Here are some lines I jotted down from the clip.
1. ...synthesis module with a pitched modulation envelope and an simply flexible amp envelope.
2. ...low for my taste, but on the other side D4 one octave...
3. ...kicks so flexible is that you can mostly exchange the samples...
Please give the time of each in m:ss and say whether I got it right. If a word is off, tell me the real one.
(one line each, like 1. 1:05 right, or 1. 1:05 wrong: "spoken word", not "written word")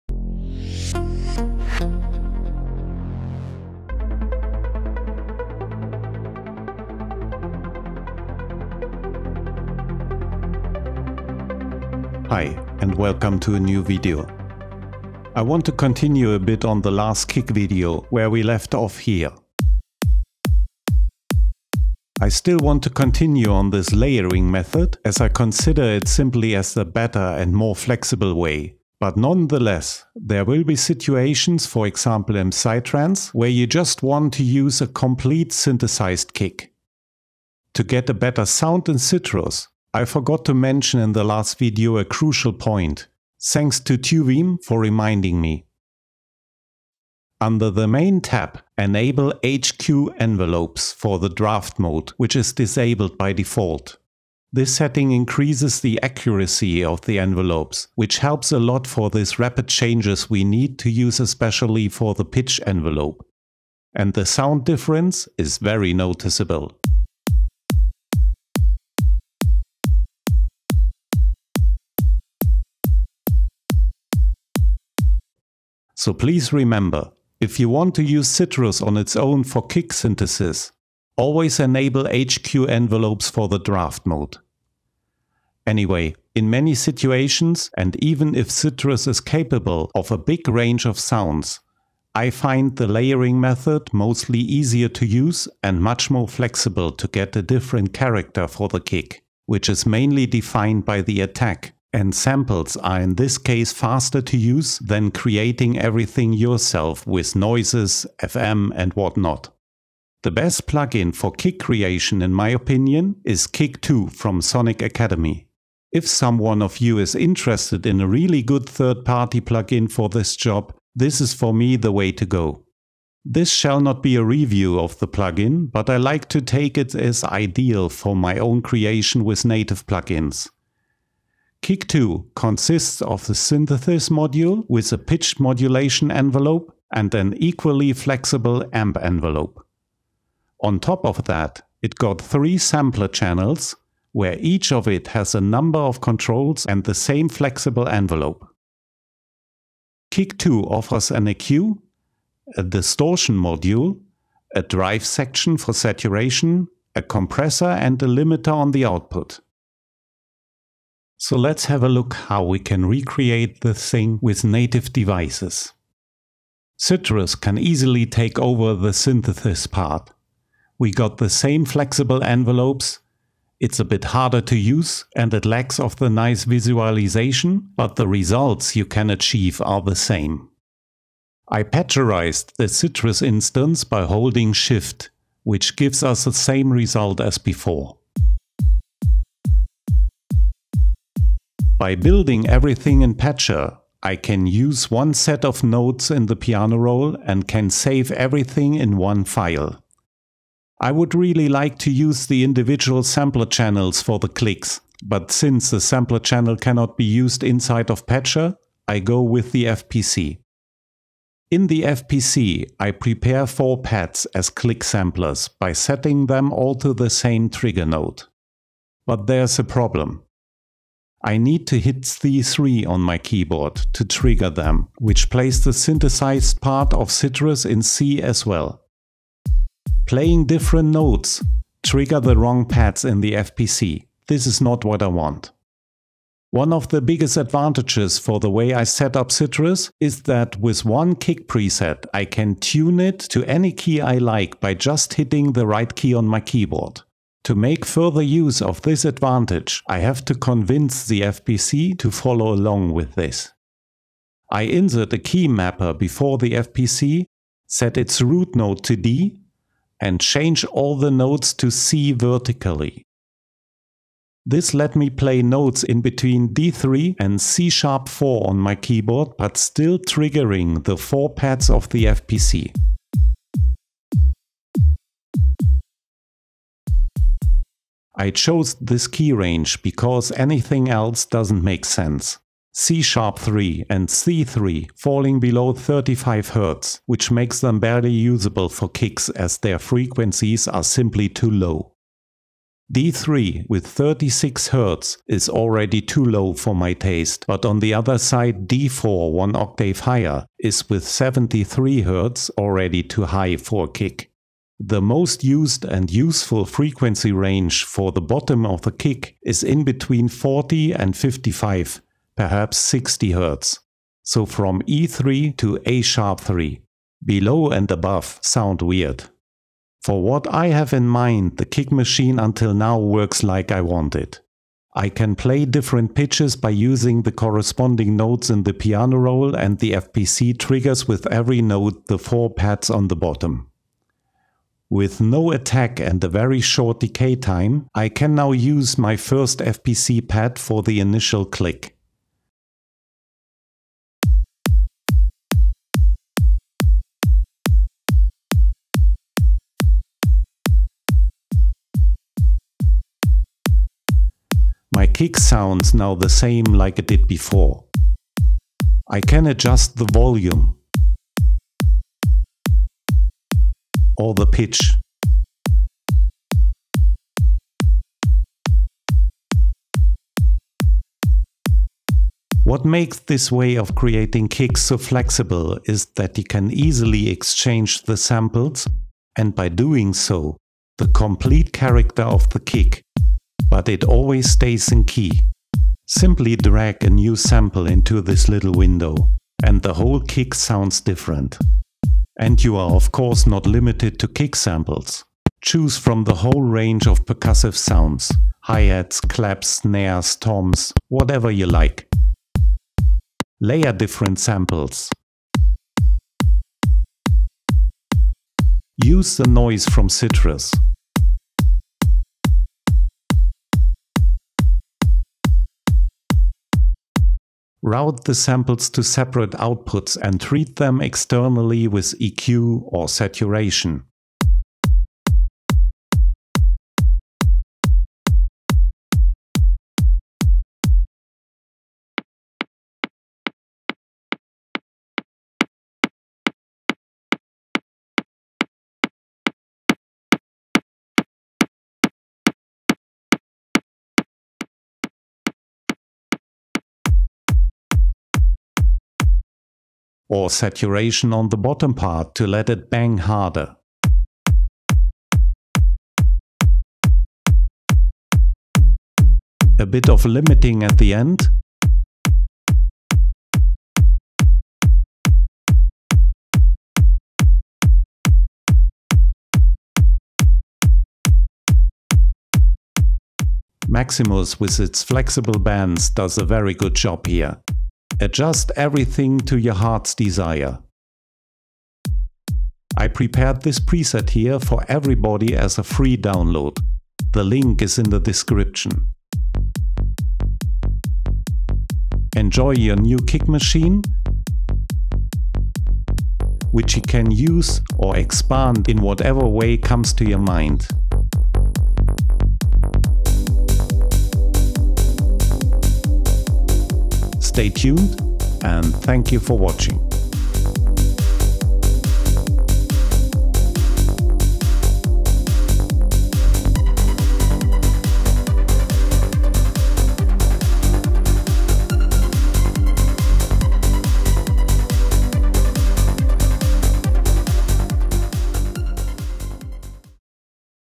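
1. 2:13 wrong: "equally", not "simply"
2. 4:56 right
3. 6:14 wrong: "easily", not "mostly".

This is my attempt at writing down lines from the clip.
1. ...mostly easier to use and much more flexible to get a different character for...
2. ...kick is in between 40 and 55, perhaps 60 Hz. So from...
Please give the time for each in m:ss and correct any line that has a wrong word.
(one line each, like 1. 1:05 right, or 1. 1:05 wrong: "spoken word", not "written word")
1. 1:33 right
2. 5:08 right.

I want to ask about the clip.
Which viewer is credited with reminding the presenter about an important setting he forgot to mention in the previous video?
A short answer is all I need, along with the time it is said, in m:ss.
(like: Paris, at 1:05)
Tuvim, at 0:43.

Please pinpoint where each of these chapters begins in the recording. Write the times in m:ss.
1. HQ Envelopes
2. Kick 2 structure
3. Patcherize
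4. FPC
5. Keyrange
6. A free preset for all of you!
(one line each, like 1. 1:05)
1. 0:37
2. 1:50
3. 2:46
4. 3:25
5. 4:38
6. 8:00.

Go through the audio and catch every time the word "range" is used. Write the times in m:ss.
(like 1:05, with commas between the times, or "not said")
1:30, 4:39, 5:07, 6:36.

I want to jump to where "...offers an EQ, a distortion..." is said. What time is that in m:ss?
2:30.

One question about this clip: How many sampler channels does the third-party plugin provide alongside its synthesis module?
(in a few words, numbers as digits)
3.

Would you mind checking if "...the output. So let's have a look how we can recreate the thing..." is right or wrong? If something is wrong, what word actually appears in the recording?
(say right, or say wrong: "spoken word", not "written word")
right.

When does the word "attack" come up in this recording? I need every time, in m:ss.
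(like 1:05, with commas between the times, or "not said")
1:41, 5:35.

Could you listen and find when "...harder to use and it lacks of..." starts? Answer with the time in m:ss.
2:54.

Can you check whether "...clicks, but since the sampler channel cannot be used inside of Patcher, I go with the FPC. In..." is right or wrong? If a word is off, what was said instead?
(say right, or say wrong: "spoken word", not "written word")
right.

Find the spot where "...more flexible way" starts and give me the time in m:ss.
0:27.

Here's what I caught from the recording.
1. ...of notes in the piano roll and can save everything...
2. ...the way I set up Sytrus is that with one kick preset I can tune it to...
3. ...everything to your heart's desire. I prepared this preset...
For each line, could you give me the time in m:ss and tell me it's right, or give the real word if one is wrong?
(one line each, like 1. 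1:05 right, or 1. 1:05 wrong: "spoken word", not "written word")
1. 3:15 right
2. 3:58 right
3. 7:58 right.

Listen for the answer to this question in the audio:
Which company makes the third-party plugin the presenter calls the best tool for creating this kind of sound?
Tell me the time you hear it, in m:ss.
1:54.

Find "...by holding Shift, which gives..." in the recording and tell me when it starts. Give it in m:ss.
3:03.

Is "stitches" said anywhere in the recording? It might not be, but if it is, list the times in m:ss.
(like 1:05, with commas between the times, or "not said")
not said.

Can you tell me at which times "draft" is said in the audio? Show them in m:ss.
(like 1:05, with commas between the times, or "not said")
0:51, 1:23.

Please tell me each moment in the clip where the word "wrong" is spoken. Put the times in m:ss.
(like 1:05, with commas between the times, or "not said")
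3:52.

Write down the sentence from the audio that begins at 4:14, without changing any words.
I insert a key mapper before the FPC, set its root node to D, and change all the nodes to C vertically.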